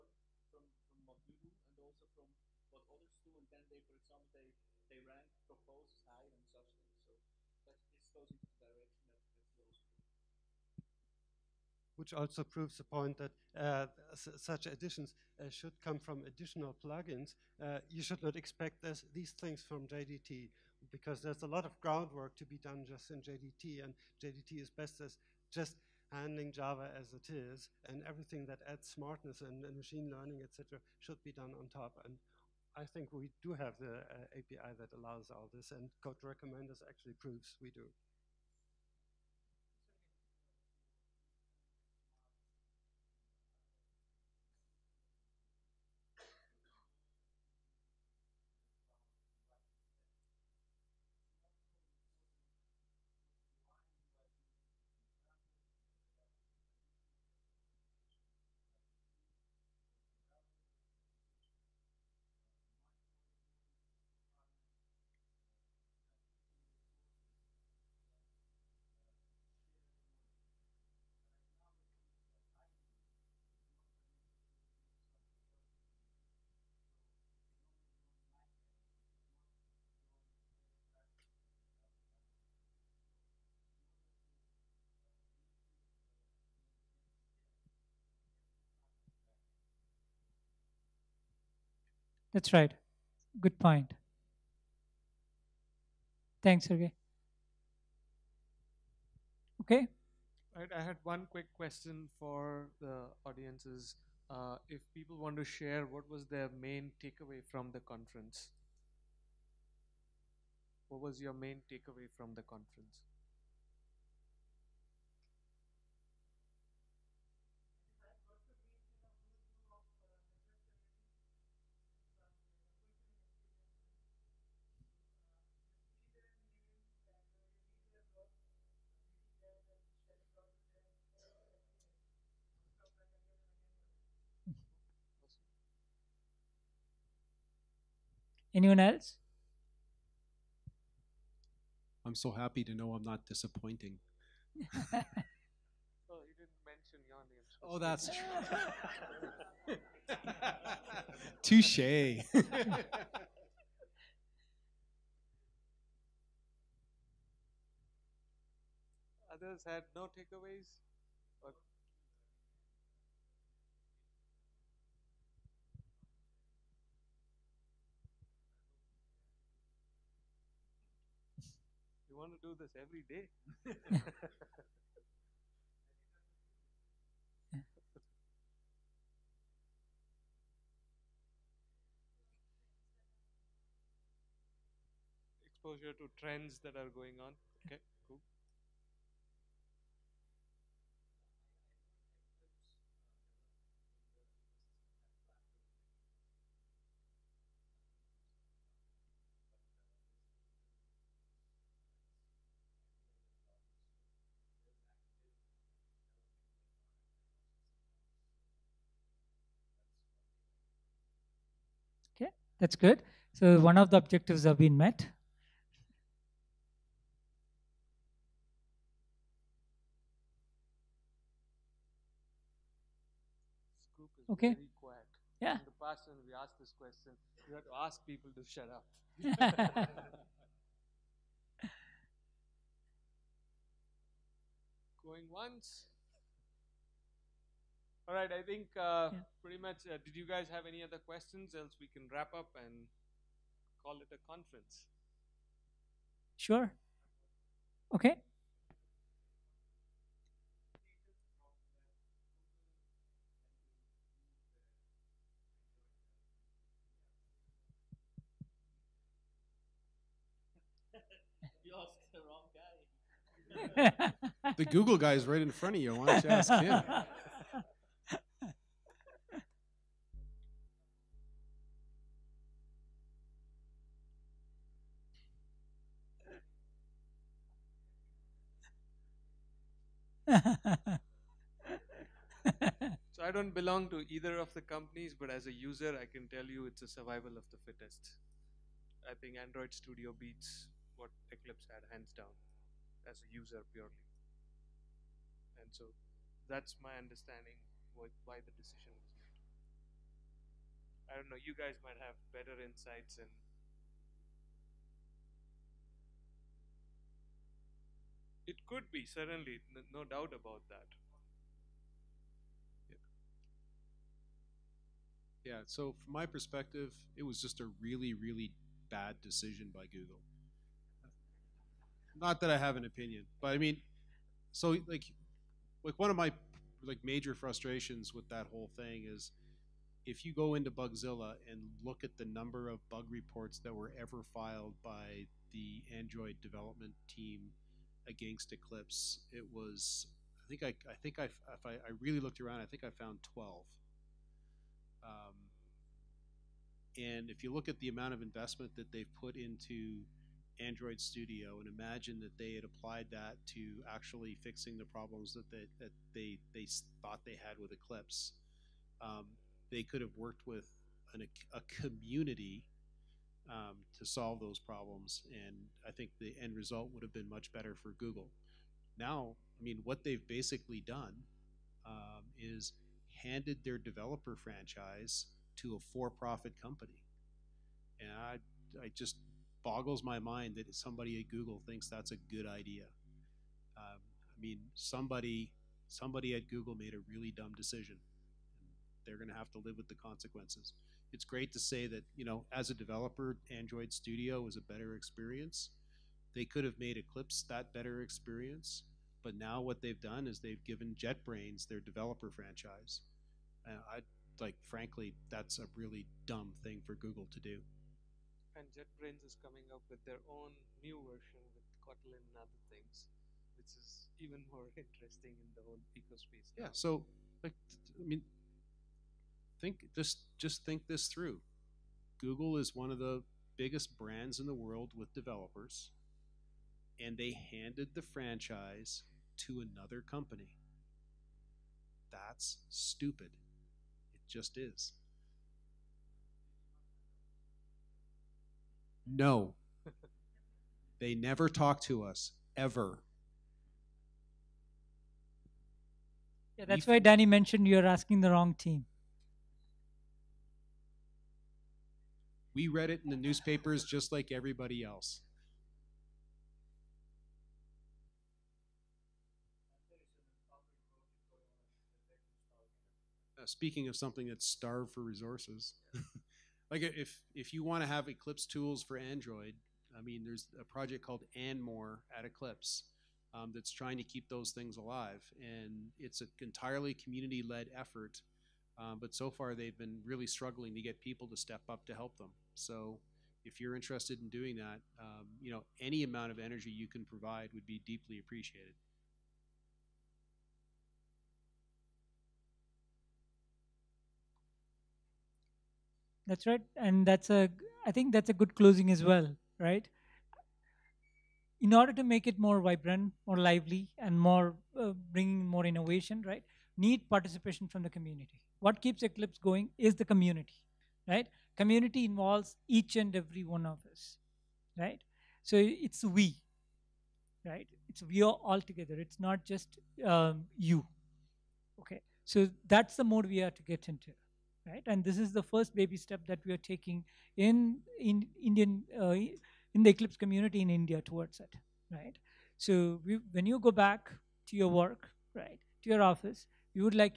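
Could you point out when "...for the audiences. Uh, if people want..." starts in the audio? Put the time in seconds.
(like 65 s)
102 s.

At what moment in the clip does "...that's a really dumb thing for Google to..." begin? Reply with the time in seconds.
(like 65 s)
405 s.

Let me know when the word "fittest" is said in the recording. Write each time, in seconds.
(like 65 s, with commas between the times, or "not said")
287 s.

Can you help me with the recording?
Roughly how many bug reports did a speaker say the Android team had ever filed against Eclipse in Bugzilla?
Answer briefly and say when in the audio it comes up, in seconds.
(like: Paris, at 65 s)
12, at 343 s.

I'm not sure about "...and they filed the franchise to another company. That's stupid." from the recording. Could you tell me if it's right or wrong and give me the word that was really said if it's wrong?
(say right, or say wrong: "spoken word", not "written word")
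wrong: "handed", not "filed".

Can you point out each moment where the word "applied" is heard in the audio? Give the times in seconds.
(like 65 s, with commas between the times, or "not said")
352 s.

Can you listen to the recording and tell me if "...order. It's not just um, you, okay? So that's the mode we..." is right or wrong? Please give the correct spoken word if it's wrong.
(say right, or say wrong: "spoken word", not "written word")
wrong: "together", not "order".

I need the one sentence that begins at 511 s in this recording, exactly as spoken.
Community involves each and every one of us, right?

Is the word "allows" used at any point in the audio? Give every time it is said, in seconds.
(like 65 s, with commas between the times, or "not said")
34 s.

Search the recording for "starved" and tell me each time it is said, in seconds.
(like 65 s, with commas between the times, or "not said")
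464 s.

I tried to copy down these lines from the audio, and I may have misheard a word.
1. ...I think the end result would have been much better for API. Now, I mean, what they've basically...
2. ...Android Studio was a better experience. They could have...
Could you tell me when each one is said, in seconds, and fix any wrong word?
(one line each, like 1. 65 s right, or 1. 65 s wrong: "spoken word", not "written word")
1. 365 s wrong: "Google", not "API"
2. 393 s right.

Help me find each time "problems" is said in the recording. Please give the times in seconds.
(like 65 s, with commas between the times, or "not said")
354 s, 364 s.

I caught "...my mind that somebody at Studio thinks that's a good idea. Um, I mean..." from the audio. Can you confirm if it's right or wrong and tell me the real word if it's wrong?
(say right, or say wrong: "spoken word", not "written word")
wrong: "Google", not "Studio".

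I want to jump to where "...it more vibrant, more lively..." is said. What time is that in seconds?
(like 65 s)
502 s.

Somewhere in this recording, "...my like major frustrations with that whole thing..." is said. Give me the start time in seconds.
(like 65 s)
326 s.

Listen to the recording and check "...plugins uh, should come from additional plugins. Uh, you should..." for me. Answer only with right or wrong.
wrong.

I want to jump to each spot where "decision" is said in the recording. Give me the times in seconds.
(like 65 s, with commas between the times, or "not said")
298 s, 319 s, 387 s.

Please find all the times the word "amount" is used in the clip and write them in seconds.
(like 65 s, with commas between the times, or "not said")
347 s, 486 s.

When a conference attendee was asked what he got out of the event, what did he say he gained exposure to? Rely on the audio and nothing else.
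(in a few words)
Trends.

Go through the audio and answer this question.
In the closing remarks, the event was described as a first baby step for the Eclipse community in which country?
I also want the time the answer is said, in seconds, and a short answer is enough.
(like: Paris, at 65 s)
India, at 530 s.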